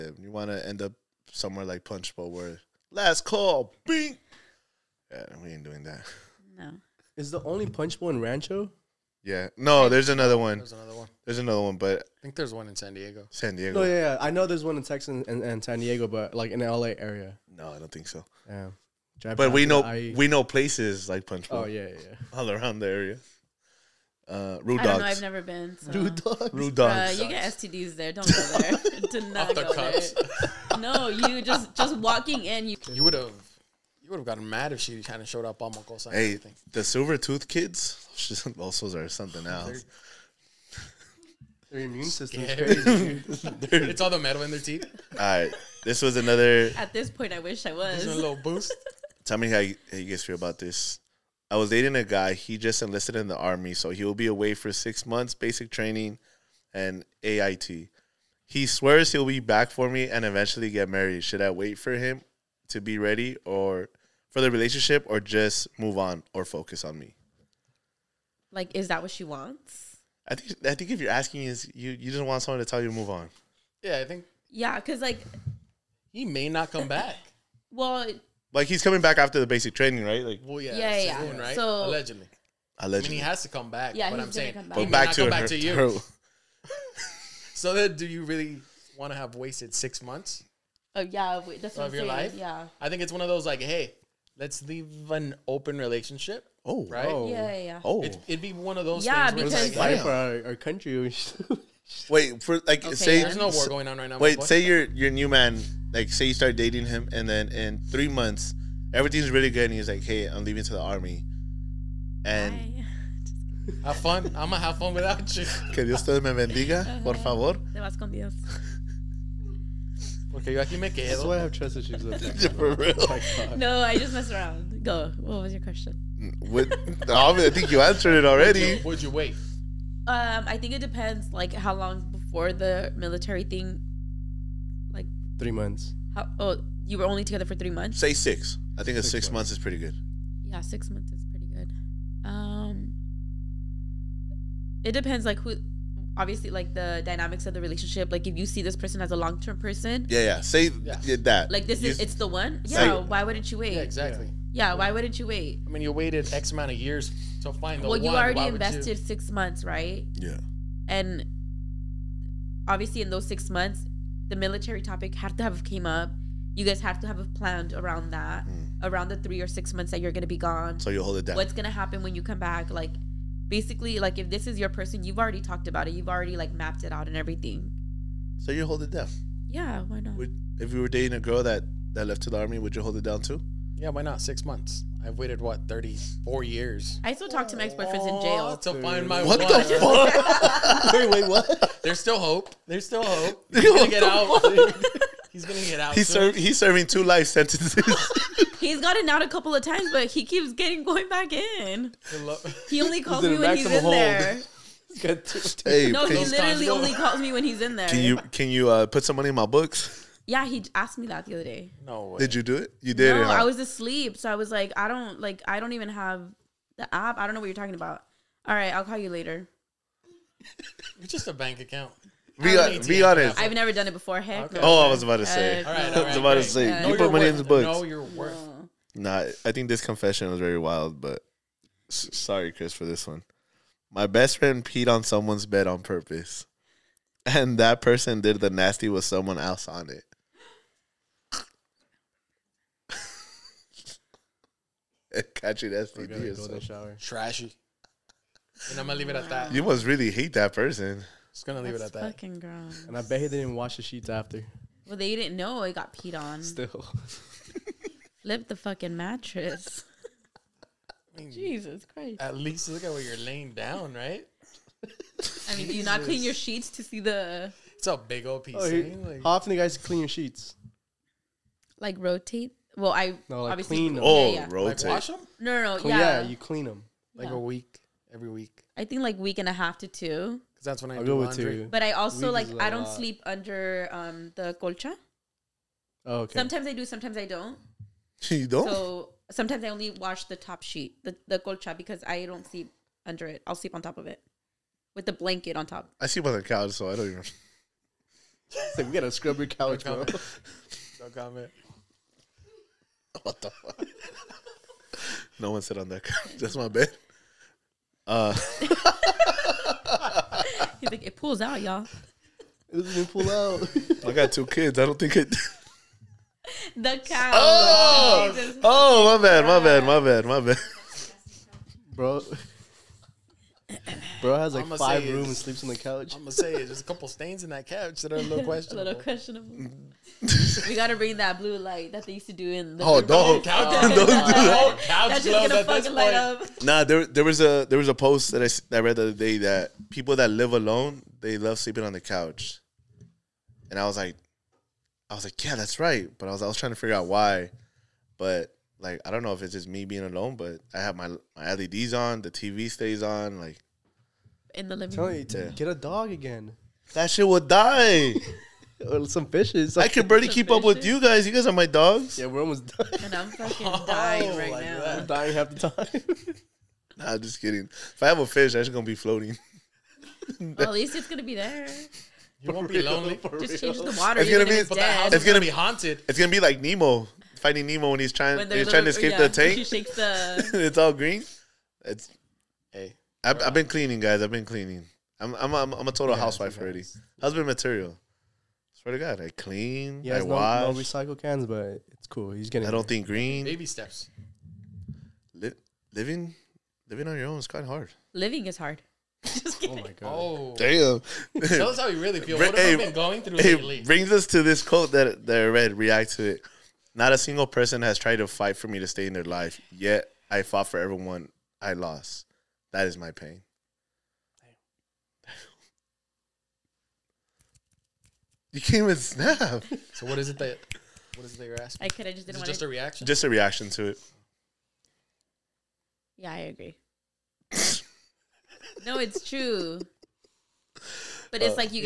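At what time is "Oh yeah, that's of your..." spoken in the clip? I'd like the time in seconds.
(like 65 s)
90 s.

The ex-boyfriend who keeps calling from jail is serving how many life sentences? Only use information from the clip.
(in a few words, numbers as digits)
2.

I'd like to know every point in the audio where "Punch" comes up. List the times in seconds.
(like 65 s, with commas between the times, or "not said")
1 s, 7 s, 21 s.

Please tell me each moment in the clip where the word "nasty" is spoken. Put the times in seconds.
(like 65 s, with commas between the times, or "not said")
238 s, 245 s.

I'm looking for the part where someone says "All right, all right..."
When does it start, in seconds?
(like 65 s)
225 s.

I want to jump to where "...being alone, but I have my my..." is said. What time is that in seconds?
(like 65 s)
349 s.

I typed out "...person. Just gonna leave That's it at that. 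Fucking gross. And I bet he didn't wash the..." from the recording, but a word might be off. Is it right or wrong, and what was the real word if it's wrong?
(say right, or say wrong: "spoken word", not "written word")
right.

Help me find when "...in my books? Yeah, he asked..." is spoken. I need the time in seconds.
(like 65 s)
209 s.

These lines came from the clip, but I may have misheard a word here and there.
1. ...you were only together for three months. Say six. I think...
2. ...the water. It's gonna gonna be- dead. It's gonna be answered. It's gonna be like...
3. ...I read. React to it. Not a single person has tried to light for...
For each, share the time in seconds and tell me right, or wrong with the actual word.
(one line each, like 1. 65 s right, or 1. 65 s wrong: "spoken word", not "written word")
1. 136 s right
2. 373 s wrong: "haunted", not "answered"
3. 405 s wrong: "fight", not "light".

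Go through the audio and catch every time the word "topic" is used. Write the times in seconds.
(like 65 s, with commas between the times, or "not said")
164 s.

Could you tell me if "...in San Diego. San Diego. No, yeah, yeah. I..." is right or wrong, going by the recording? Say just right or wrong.
right.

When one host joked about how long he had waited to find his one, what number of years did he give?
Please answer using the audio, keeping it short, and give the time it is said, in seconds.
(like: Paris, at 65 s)
34, at 185 s.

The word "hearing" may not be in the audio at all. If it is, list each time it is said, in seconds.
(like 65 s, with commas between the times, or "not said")
not said.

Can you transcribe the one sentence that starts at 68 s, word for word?
Like, is that what she wants?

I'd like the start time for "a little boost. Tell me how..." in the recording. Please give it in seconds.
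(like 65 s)
48 s.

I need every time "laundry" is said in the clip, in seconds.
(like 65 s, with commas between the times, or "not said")
281 s.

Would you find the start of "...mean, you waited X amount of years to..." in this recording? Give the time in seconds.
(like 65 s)
155 s.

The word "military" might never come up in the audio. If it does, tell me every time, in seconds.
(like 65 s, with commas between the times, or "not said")
132 s, 164 s.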